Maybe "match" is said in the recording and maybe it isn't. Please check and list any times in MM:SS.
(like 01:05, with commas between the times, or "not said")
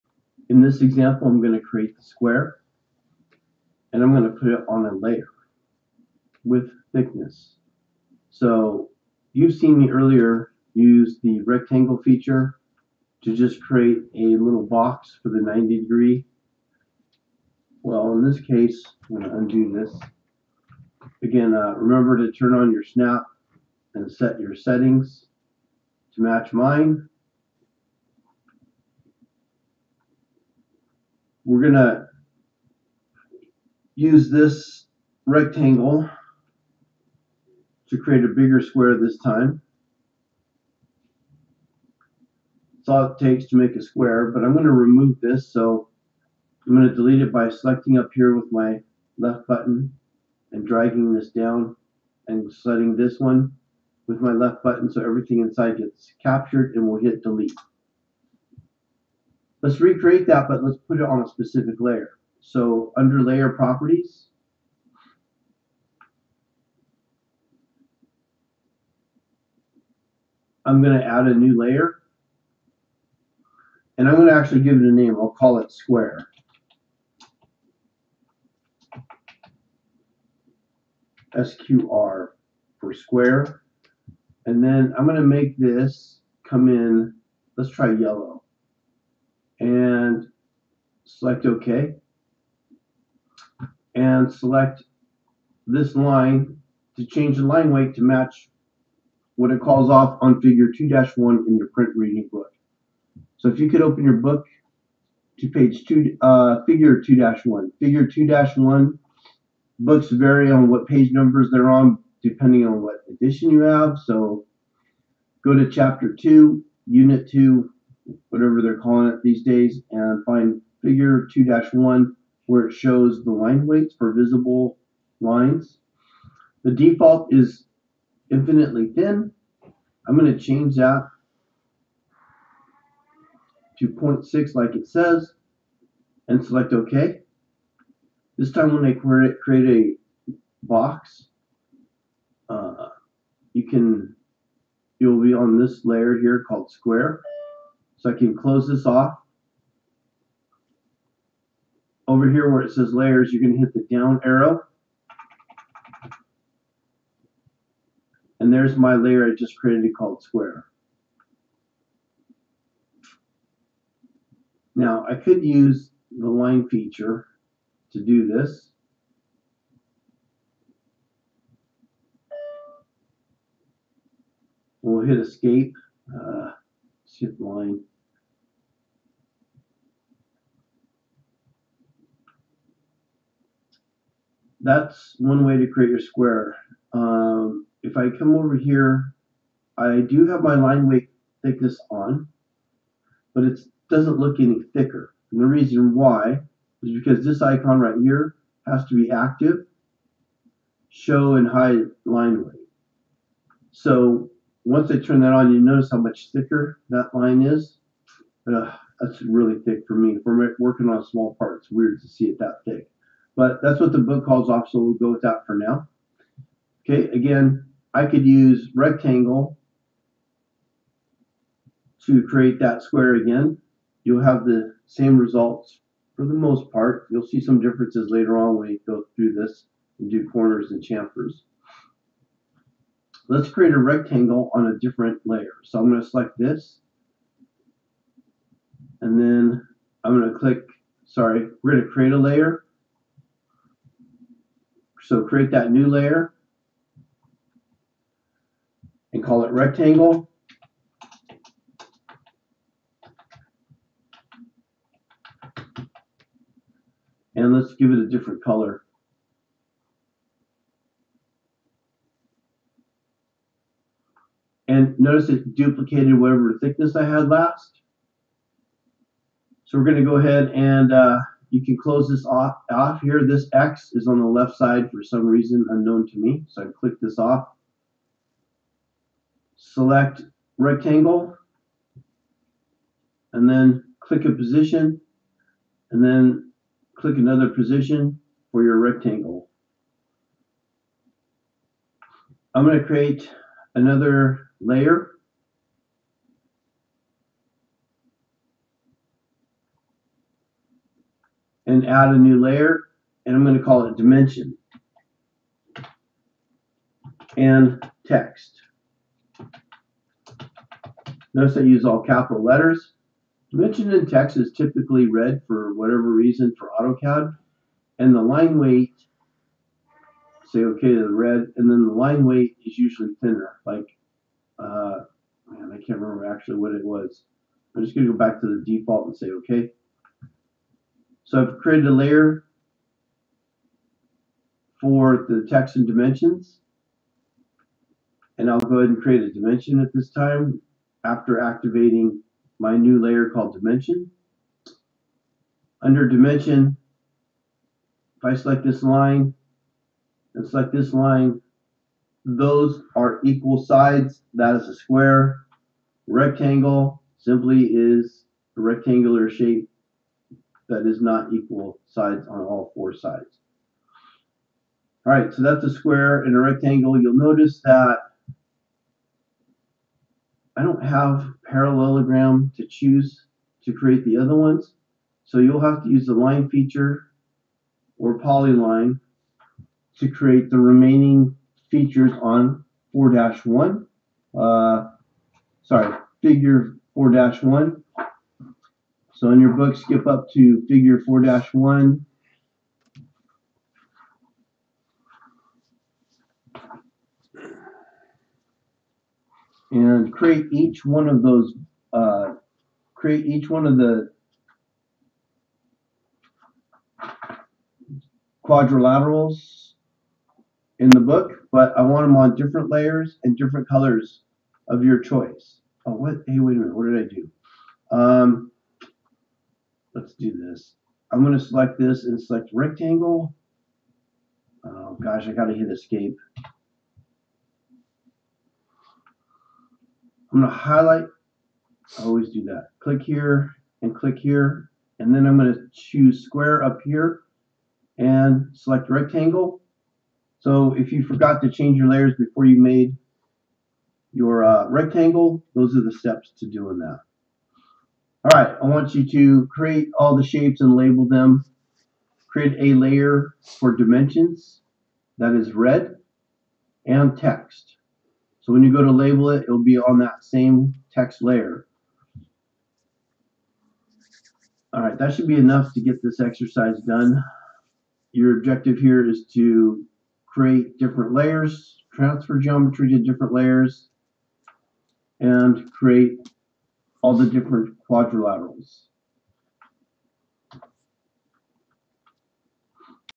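00:26, 01:38.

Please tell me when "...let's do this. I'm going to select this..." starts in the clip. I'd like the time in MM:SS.
06:59.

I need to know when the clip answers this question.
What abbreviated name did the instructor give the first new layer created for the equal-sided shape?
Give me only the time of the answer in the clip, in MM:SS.
01:21.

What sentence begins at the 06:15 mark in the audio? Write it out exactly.
So you'll have to use the line feature or polyline to create the remaining features on 4-1.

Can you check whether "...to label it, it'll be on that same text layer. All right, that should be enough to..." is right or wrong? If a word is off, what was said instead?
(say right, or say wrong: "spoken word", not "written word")
right.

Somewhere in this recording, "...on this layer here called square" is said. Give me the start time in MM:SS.
02:25.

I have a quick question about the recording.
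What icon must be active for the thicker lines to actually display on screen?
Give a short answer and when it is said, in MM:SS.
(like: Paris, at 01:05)
show and hide line weight, at 03:20.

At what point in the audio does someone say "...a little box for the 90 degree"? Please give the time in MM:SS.
00:14.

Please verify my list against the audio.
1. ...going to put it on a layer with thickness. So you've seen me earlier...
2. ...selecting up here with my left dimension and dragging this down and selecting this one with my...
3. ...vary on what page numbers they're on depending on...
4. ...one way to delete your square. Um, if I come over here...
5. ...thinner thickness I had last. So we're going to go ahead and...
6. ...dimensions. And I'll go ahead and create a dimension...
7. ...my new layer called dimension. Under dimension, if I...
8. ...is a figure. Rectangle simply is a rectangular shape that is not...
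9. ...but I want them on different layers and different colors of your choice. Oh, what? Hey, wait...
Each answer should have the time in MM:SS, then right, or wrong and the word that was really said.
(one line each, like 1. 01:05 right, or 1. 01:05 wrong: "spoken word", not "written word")
1. 00:04 right
2. 00:47 wrong: "button", not "dimension"
3. 01:50 right
4. 03:05 wrong: "create", not "delete"
5. 04:26 wrong: "whatever", not "thinner"
6. 05:35 right
7. 05:42 right
8. 05:54 wrong: "square", not "figure"
9. 06:51 right.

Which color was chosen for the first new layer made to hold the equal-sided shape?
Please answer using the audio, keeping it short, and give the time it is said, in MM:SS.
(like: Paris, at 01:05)
yellow, at 01:27.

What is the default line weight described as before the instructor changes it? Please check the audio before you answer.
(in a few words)
infinitely thin.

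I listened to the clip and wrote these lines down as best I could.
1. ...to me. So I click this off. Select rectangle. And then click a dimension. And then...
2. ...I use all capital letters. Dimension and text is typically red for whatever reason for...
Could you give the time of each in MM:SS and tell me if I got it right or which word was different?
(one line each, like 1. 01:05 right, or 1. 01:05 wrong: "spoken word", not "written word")
1. 04:36 wrong: "position", not "dimension"
2. 05:11 right.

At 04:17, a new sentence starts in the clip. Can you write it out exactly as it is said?
And let's give it a different color.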